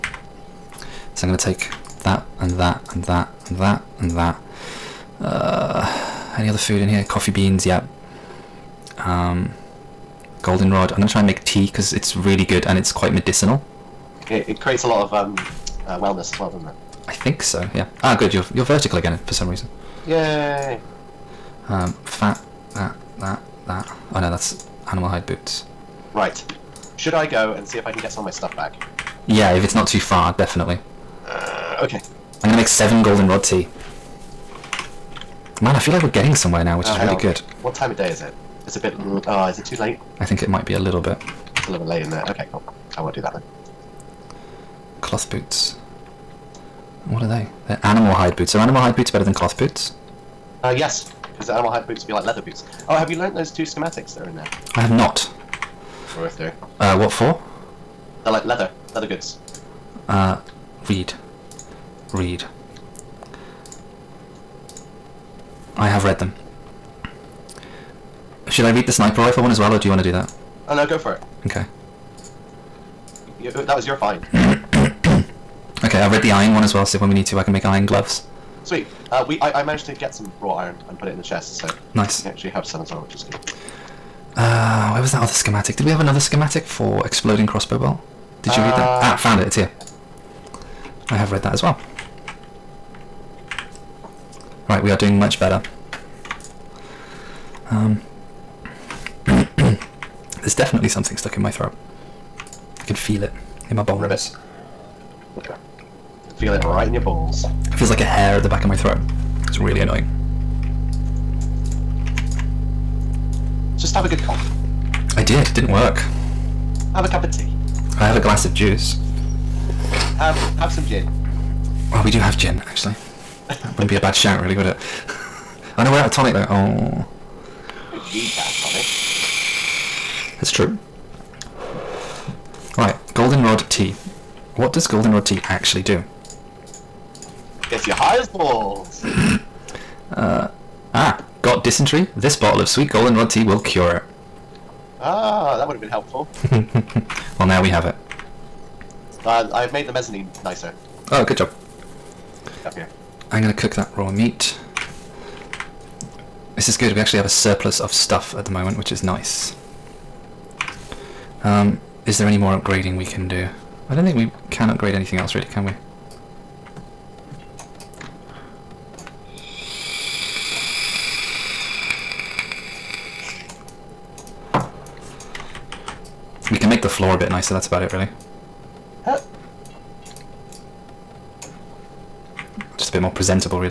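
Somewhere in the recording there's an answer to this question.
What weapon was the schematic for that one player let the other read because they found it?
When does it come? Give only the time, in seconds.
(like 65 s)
68 s.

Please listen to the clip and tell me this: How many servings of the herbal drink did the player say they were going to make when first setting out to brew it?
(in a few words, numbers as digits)
7.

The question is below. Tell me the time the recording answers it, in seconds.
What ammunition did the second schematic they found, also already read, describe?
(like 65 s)
87 s.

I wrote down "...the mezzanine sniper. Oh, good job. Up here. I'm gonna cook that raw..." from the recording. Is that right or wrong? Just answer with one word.
wrong.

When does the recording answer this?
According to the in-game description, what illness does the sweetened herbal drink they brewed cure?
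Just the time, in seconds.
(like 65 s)
141 s.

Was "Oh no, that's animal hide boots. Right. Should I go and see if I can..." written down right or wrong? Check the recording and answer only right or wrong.
right.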